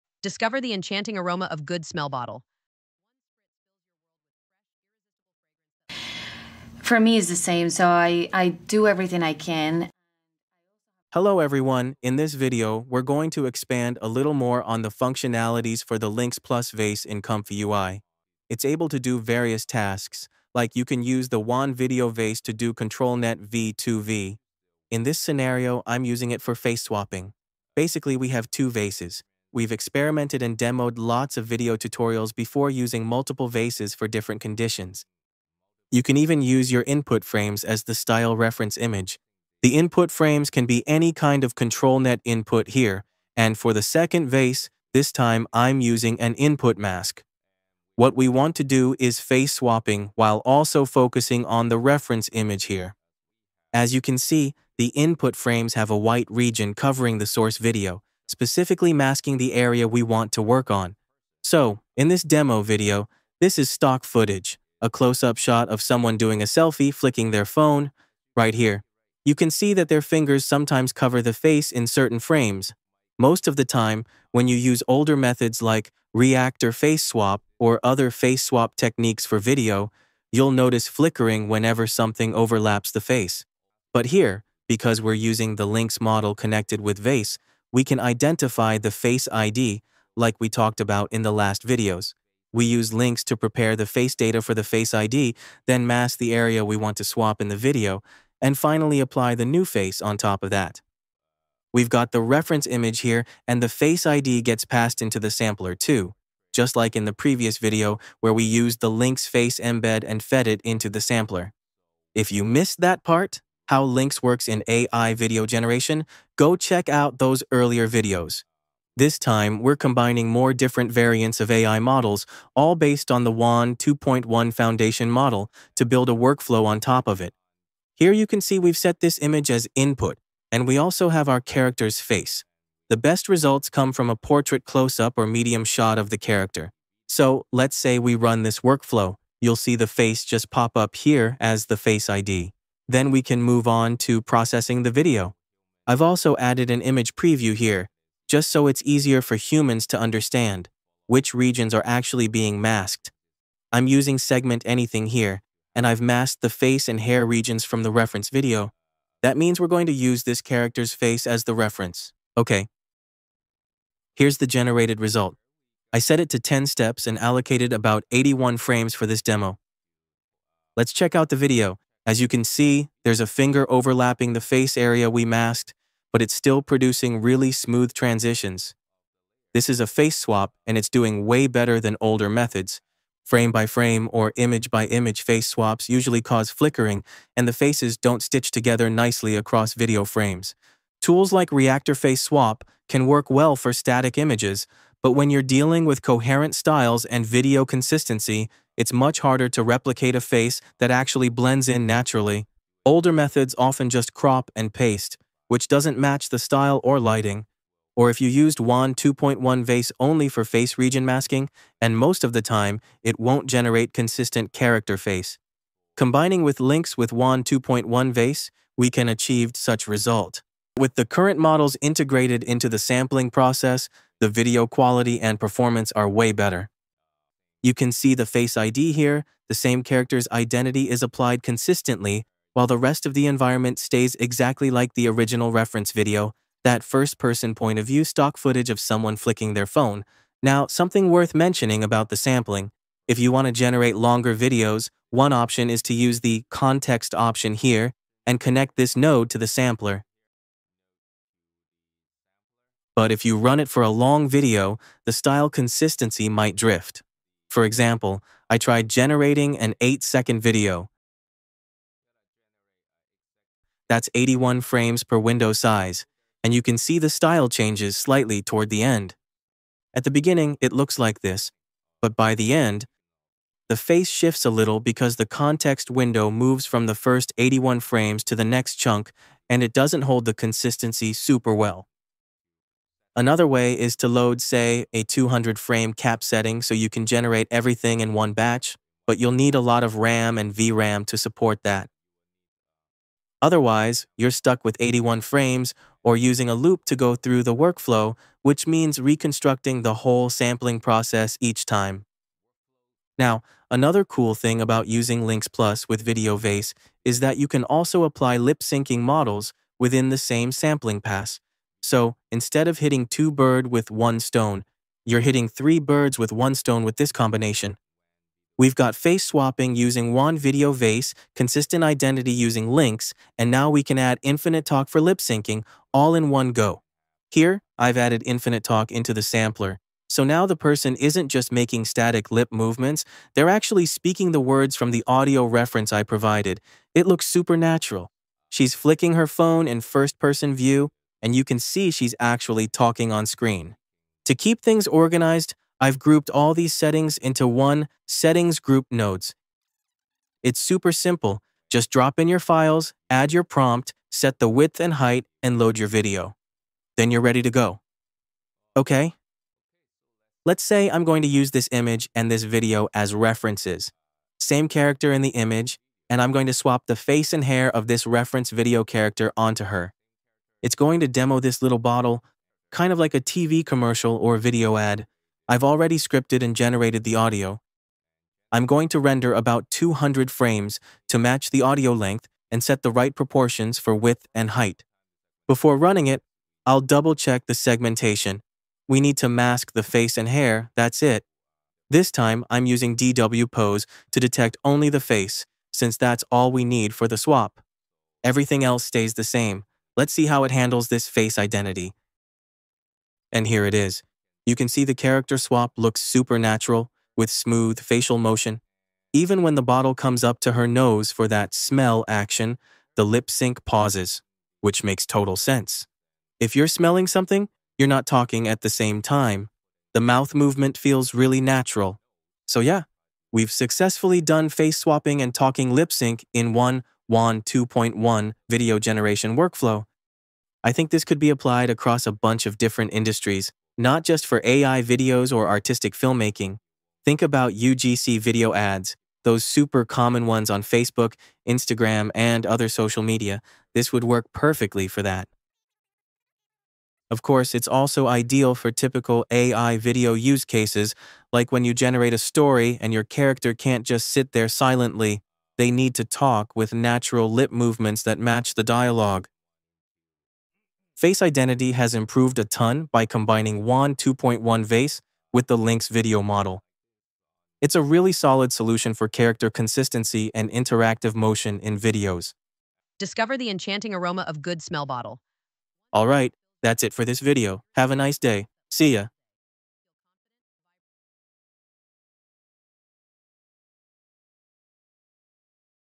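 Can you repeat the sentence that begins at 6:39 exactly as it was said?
Let's see how it handles this face identity.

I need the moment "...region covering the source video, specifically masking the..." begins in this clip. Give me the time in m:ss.
0:56.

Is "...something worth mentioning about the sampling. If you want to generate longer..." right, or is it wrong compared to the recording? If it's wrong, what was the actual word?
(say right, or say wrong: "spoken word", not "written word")
right.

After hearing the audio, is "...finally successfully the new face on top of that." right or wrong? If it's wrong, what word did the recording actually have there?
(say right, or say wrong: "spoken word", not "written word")
wrong: "apply", not "successfully".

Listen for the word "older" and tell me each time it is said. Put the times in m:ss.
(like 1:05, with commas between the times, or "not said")
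1:14, 3:02, 3:22.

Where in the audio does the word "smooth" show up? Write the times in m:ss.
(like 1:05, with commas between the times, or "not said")
2:57, 6:47.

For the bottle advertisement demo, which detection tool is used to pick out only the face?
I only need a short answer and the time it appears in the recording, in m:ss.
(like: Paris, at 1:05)
DW Pose, at 6:32.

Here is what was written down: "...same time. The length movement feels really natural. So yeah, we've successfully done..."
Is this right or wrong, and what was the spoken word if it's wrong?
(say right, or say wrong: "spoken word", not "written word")
wrong: "mouth", not "length".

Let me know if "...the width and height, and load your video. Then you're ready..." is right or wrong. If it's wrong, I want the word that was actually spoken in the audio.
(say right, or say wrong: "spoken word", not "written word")
right.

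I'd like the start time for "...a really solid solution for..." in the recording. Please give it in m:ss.
7:47.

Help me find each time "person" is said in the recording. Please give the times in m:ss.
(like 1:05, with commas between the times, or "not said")
3:56, 5:30, 5:40.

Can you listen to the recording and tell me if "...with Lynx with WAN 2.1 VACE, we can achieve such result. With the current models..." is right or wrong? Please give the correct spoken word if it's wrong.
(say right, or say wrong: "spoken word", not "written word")
right.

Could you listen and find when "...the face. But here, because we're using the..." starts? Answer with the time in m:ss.
1:22.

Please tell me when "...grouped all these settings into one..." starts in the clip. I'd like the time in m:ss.
5:45.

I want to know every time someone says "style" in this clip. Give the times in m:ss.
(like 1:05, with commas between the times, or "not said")
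0:37, 3:16, 3:26, 4:15, 4:27.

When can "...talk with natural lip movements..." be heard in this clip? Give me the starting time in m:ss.
7:36.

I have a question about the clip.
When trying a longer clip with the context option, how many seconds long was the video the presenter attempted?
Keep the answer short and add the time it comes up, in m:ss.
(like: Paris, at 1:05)
8 seconds, at 4:19.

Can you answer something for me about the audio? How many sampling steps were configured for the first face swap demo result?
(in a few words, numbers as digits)
10.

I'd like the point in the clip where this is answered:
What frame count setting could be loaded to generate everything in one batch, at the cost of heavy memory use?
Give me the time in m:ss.
4:45.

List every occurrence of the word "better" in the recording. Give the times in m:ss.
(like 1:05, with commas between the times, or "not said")
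3:01, 3:46.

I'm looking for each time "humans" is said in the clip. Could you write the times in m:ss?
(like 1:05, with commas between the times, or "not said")
2:29.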